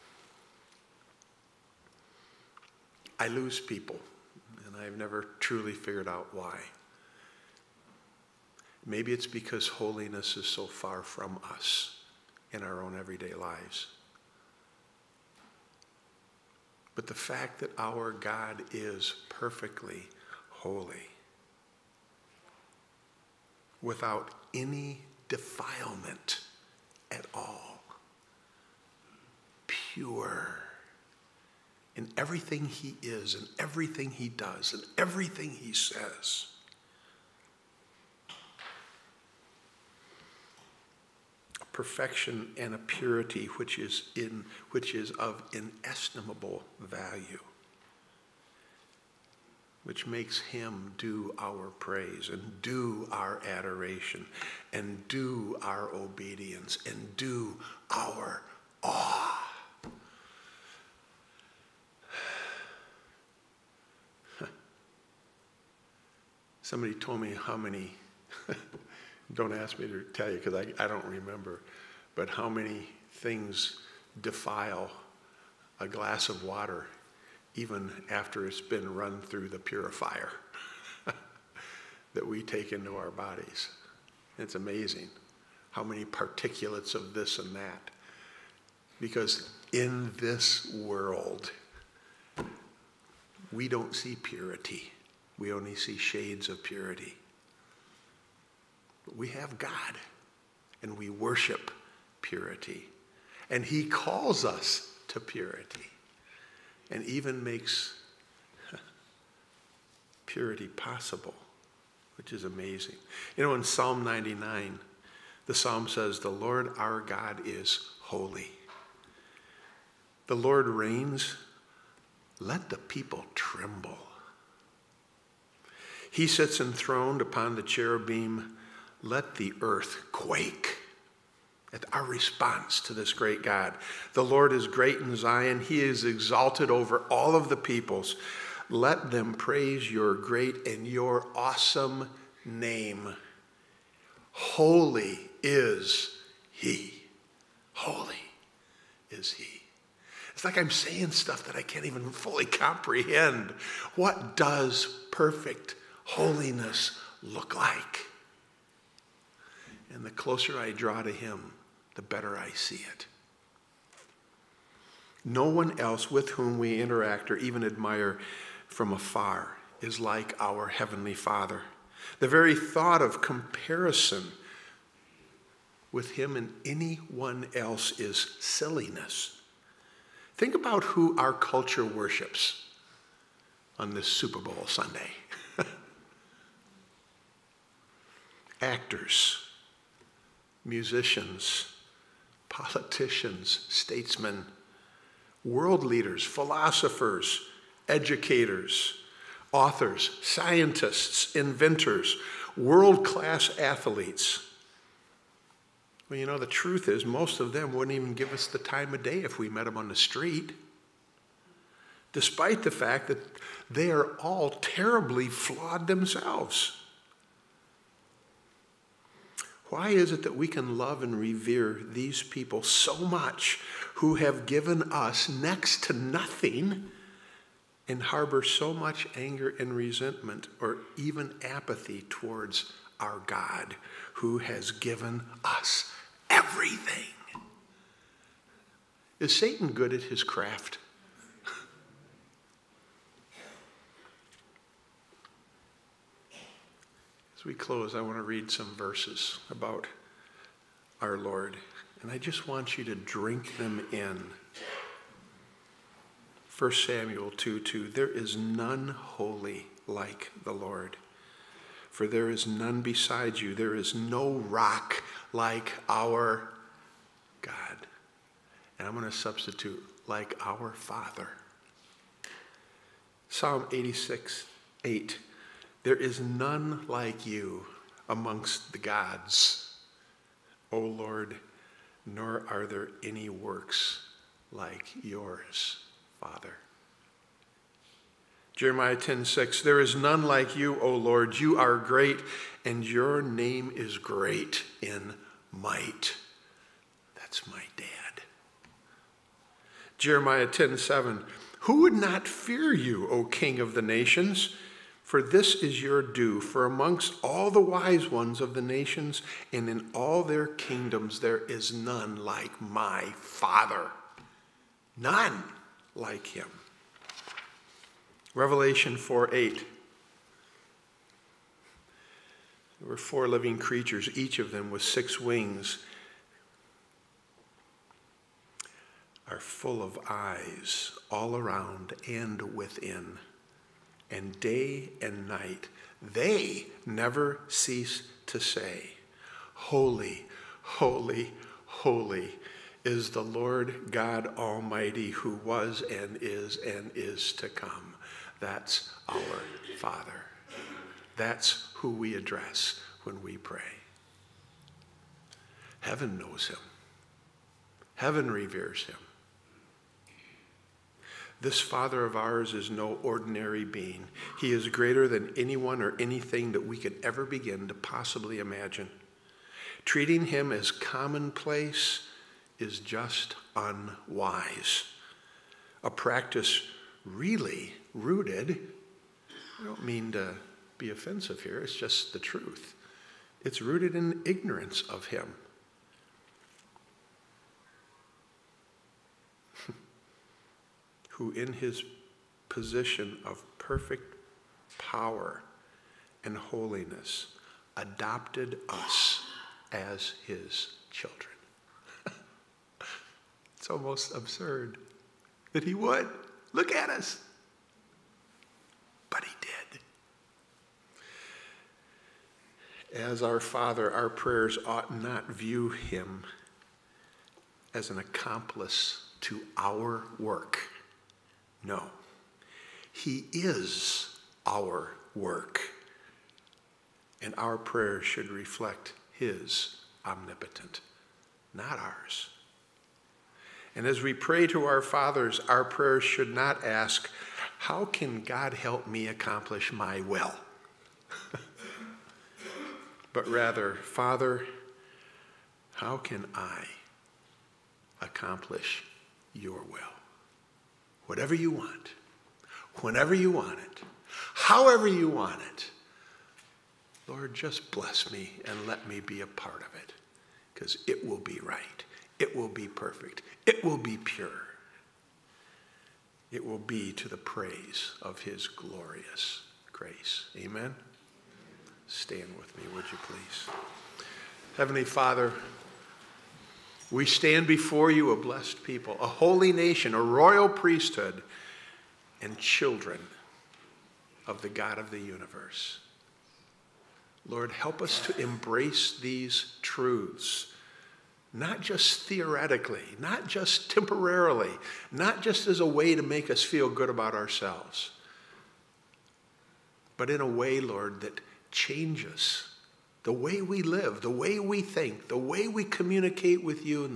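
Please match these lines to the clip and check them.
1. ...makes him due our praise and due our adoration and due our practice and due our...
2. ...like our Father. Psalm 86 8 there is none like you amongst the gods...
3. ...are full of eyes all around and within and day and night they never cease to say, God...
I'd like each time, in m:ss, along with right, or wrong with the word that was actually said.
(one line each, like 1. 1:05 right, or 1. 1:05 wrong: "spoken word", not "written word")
1. 0:50 wrong: "obedience", not "practice"
2. 4:30 right
3. 5:29 wrong: "Holy", not "God".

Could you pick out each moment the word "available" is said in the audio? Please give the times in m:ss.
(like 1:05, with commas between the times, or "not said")
not said.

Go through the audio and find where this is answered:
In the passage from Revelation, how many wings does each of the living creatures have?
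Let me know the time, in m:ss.
5:24.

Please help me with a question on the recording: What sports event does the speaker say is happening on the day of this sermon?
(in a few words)
Super Bowl Sunday.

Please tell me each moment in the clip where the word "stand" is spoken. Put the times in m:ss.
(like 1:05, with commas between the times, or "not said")
7:51, 7:57.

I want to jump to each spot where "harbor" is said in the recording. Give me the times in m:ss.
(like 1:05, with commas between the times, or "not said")
3:48.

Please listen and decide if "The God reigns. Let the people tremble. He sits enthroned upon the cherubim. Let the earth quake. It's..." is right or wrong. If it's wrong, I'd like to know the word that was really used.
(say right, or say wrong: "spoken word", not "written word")
wrong: "Lord", not "God".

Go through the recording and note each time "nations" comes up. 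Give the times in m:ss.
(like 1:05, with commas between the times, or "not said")
5:03, 5:08, 7:59.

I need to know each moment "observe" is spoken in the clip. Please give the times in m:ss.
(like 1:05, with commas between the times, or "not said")
not said.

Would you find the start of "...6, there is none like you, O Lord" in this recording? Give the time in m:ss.
4:49.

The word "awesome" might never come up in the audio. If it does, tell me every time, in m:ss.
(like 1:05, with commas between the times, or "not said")
2:21.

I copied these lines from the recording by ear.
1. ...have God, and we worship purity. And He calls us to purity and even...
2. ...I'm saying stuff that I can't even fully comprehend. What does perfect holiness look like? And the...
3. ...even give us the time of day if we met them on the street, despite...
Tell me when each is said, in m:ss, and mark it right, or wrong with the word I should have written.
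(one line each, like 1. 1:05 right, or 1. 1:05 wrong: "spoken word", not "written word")
1. 1:39 right
2. 2:30 right
3. 3:27 right.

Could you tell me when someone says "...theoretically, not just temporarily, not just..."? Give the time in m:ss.
8:12.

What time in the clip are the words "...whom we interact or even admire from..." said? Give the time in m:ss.
2:46.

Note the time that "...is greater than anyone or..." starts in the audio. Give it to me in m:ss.
6:04.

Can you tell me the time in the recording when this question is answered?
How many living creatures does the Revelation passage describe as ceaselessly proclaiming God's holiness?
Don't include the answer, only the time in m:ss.
5:22.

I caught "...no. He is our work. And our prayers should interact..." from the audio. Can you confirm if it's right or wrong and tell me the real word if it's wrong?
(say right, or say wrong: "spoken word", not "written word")
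wrong: "reflect", not "interact".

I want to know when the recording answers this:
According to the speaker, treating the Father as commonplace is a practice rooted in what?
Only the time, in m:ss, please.
6:24.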